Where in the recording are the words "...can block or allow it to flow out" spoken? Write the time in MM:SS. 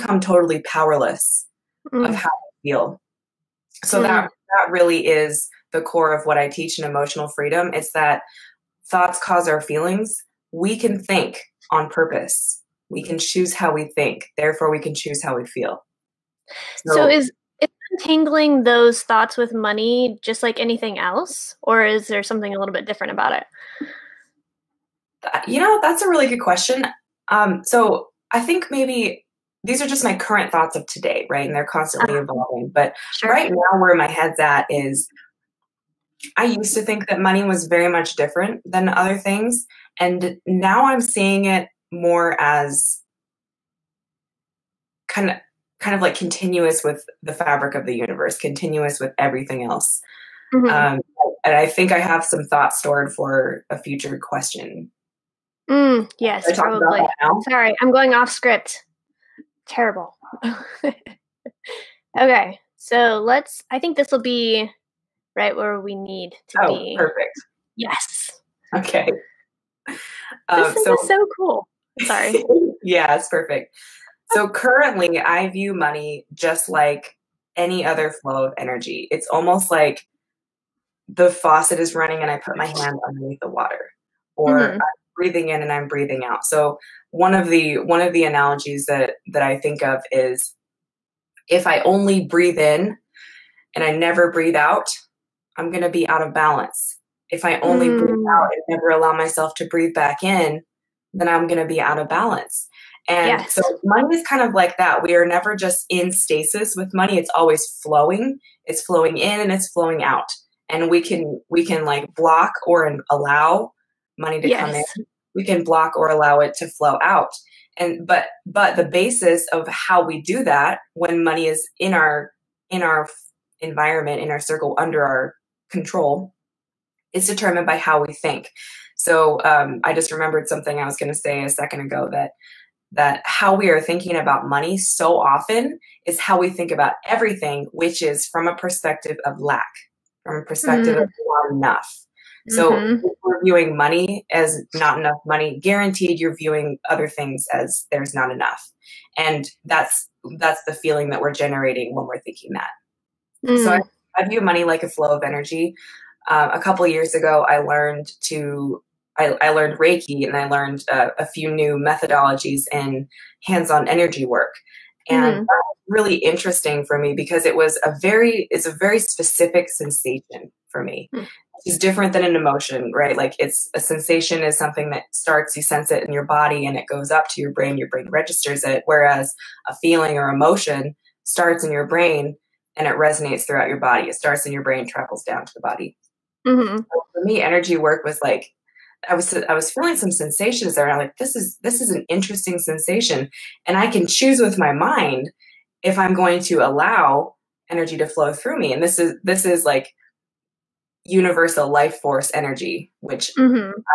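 01:55.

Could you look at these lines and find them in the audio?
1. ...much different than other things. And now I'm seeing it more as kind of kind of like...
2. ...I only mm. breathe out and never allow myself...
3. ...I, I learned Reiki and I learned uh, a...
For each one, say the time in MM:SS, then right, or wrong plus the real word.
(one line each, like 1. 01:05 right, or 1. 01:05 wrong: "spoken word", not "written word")
1. 00:37 right
2. 01:37 right
3. 02:39 right.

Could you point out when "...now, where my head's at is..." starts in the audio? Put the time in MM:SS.
00:33.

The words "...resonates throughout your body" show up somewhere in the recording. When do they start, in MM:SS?
03:02.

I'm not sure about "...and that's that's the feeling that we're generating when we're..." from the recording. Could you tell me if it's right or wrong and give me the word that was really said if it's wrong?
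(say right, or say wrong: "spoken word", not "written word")
right.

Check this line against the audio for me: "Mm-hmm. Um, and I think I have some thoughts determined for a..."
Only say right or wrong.
wrong.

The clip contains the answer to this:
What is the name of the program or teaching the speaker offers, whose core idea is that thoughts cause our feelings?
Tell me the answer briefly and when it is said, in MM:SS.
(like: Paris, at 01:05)
Emotional Freedom, at 00:06.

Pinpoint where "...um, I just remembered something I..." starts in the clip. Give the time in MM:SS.
02:09.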